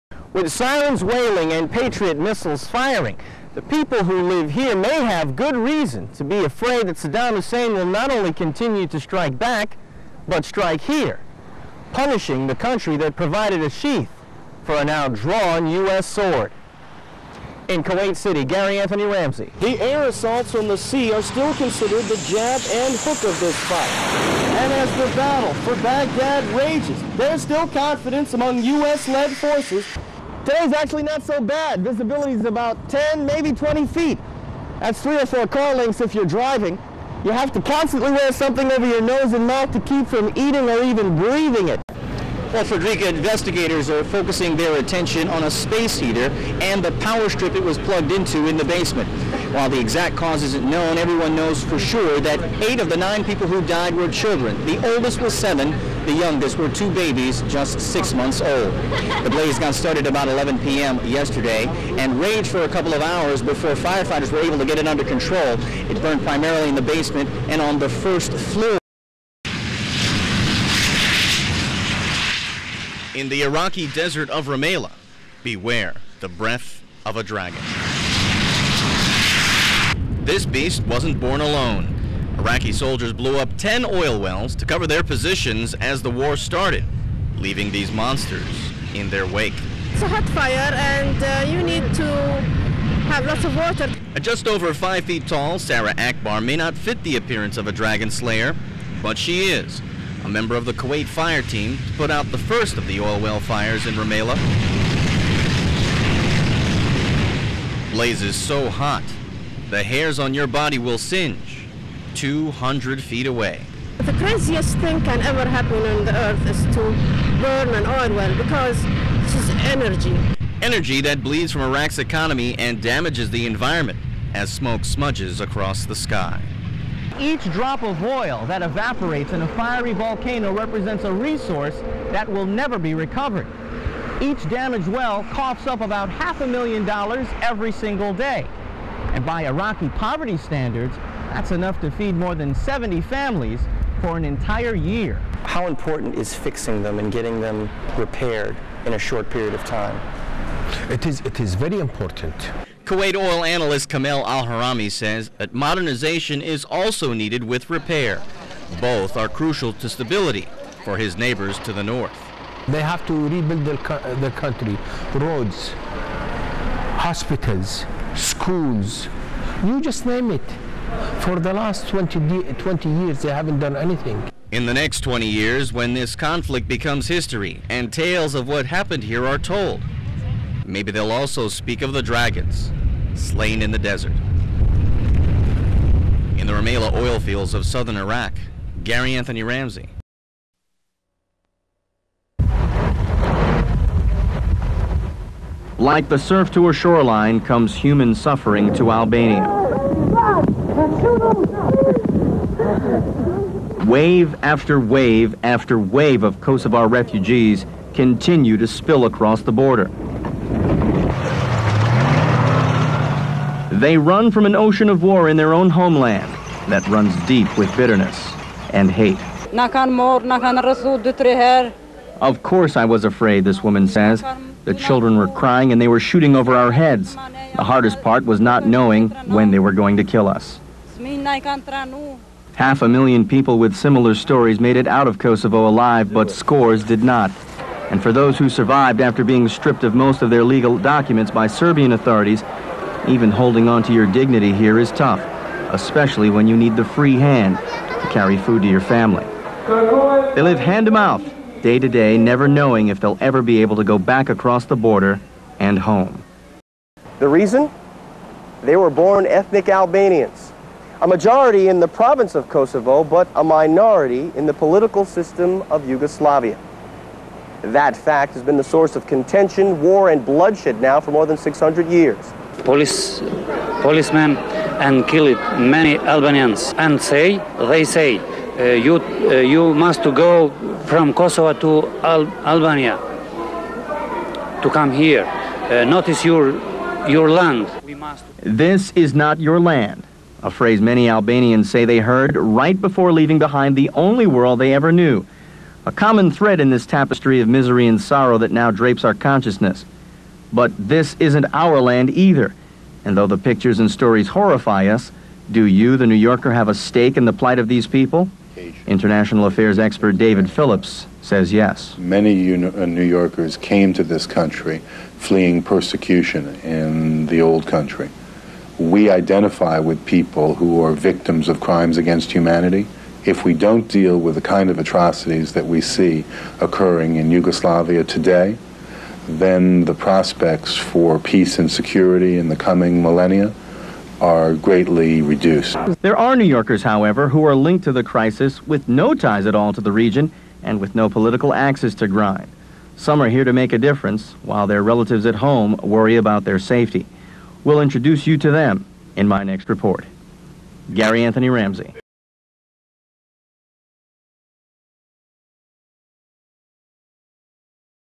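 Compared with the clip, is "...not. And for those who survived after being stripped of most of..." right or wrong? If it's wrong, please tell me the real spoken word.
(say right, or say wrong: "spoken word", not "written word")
right.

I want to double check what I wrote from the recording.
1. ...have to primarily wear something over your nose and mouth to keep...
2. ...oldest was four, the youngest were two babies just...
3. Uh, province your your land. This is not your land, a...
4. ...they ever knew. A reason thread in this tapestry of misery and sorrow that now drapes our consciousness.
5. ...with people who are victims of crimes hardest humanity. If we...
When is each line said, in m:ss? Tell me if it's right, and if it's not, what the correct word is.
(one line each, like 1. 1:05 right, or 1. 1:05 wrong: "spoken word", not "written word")
1. 0:37 wrong: "constantly", not "primarily"
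2. 0:54 wrong: "seven", not "four"
3. 4:45 wrong: "notice", not "province"
4. 4:54 wrong: "common", not "reason"
5. 5:19 wrong: "against", not "hardest".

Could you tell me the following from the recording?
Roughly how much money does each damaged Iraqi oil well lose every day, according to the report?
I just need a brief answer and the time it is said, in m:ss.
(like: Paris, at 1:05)
half a million dollars, at 2:16.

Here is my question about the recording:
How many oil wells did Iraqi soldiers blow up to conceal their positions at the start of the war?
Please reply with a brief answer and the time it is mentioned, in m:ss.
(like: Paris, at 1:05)
10, at 1:23.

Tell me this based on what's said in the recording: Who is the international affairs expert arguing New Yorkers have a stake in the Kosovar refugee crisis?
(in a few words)
David Phillips.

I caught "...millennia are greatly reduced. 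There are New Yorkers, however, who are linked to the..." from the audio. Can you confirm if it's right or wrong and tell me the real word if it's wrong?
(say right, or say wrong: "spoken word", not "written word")
right.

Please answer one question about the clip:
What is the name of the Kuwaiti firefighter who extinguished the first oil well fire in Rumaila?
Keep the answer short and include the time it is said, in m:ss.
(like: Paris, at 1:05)
Sarah Akbar, at 1:35.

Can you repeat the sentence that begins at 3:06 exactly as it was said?
In the Rumaila oil fields of southern Iraq, Gary Anthony Ramsay.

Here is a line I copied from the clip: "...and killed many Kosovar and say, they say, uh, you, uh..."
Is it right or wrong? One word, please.
wrong.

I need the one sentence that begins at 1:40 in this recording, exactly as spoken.
A member of the Kuwait fire team put out the first of the oil well fires in Rumaila.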